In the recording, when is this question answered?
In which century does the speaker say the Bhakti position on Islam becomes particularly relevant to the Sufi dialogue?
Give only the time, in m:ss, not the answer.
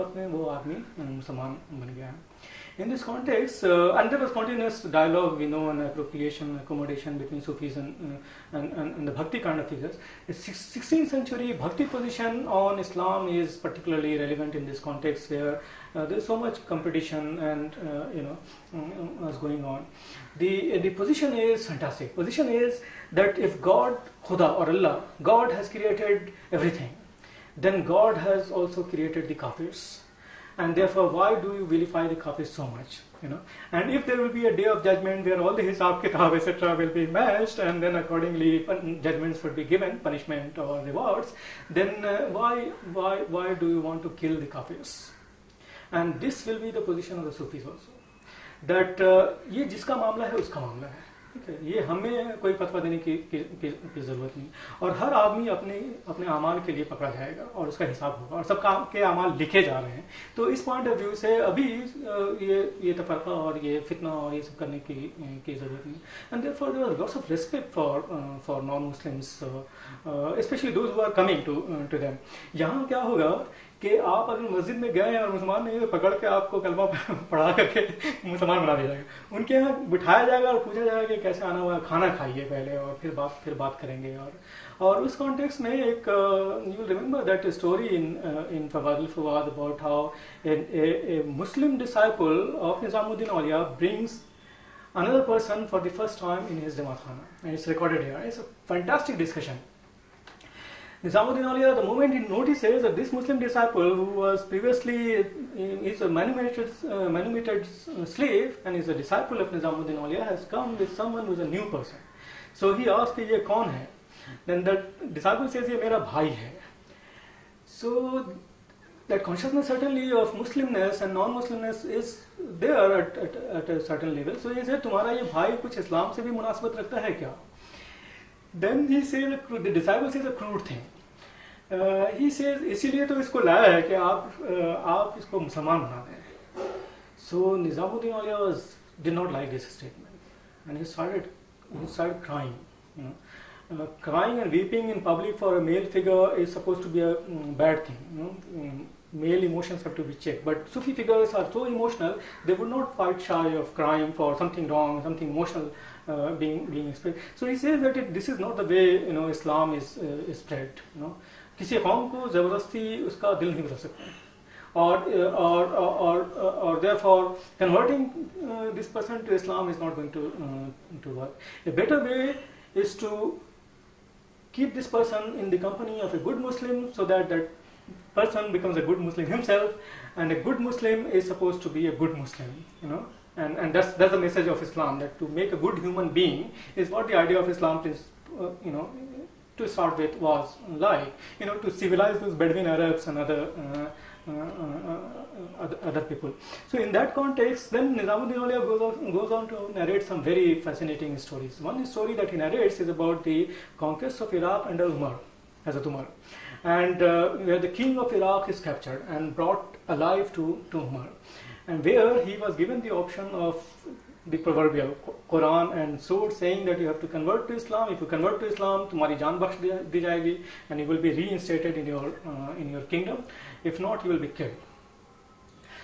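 0:10.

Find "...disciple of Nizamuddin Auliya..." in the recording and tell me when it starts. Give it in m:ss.
1:48.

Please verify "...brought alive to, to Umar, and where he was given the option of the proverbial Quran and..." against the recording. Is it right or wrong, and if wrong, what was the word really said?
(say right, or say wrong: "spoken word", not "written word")
right.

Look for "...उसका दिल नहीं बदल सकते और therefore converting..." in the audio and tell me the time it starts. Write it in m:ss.
2:43.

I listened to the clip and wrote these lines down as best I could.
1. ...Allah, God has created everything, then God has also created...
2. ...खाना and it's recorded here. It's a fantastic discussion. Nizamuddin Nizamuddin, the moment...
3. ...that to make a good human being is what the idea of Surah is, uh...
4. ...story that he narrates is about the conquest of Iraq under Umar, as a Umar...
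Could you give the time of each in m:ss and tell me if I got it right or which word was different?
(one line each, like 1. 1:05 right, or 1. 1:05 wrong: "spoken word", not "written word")
1. 0:24 right
2. 1:37 wrong: "Auliya", not "Nizamuddin"
3. 3:04 wrong: "Islam", not "Surah"
4. 3:21 right.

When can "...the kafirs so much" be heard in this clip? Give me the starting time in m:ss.
0:32.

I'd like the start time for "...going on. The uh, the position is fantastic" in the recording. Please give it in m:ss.
0:19.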